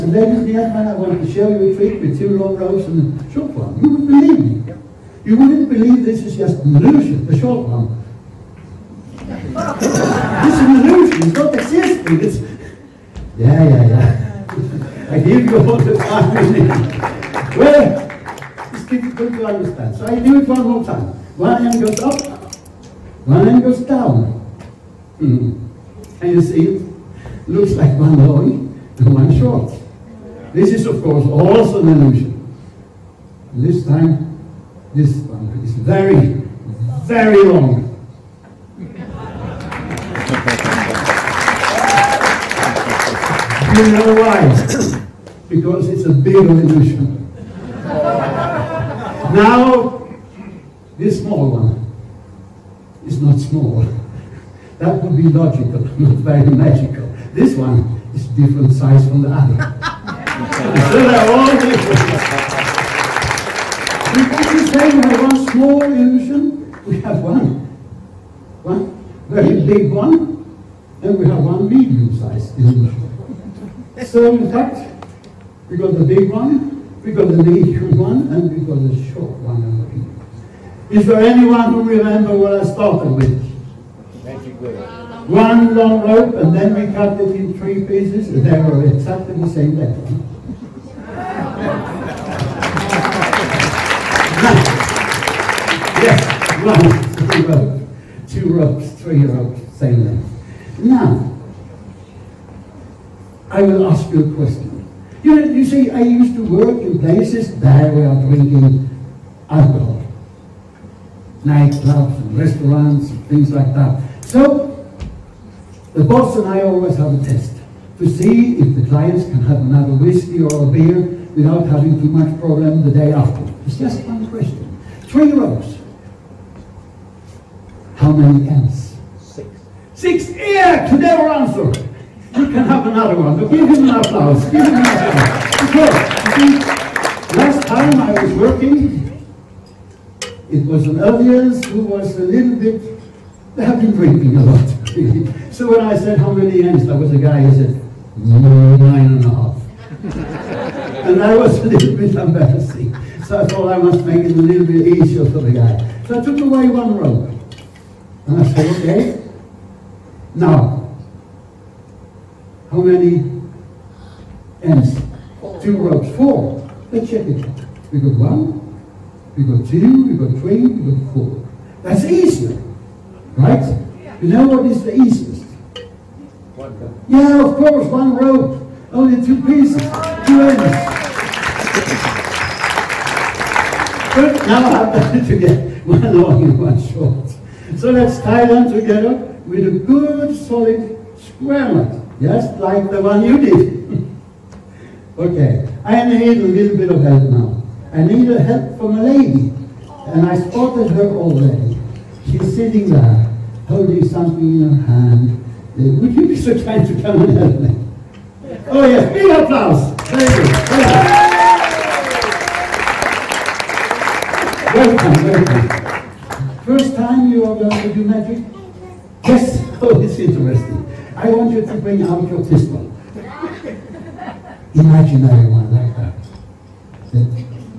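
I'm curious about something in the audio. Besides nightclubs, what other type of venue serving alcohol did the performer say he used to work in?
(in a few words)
restaurants.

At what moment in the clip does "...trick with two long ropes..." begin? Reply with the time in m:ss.
0:01.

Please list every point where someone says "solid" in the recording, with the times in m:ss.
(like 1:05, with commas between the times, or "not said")
3:10.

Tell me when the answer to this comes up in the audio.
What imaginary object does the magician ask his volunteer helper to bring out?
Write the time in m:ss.
3:42.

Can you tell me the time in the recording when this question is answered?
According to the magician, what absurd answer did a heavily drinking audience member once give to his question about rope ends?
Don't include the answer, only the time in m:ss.
2:28.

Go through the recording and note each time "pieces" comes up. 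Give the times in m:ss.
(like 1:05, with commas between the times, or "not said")
1:27, 2:59.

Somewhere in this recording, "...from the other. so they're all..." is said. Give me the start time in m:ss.
0:59.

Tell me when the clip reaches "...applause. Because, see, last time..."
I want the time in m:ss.
2:14.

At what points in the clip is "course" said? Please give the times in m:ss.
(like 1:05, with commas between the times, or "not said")
0:31, 2:57.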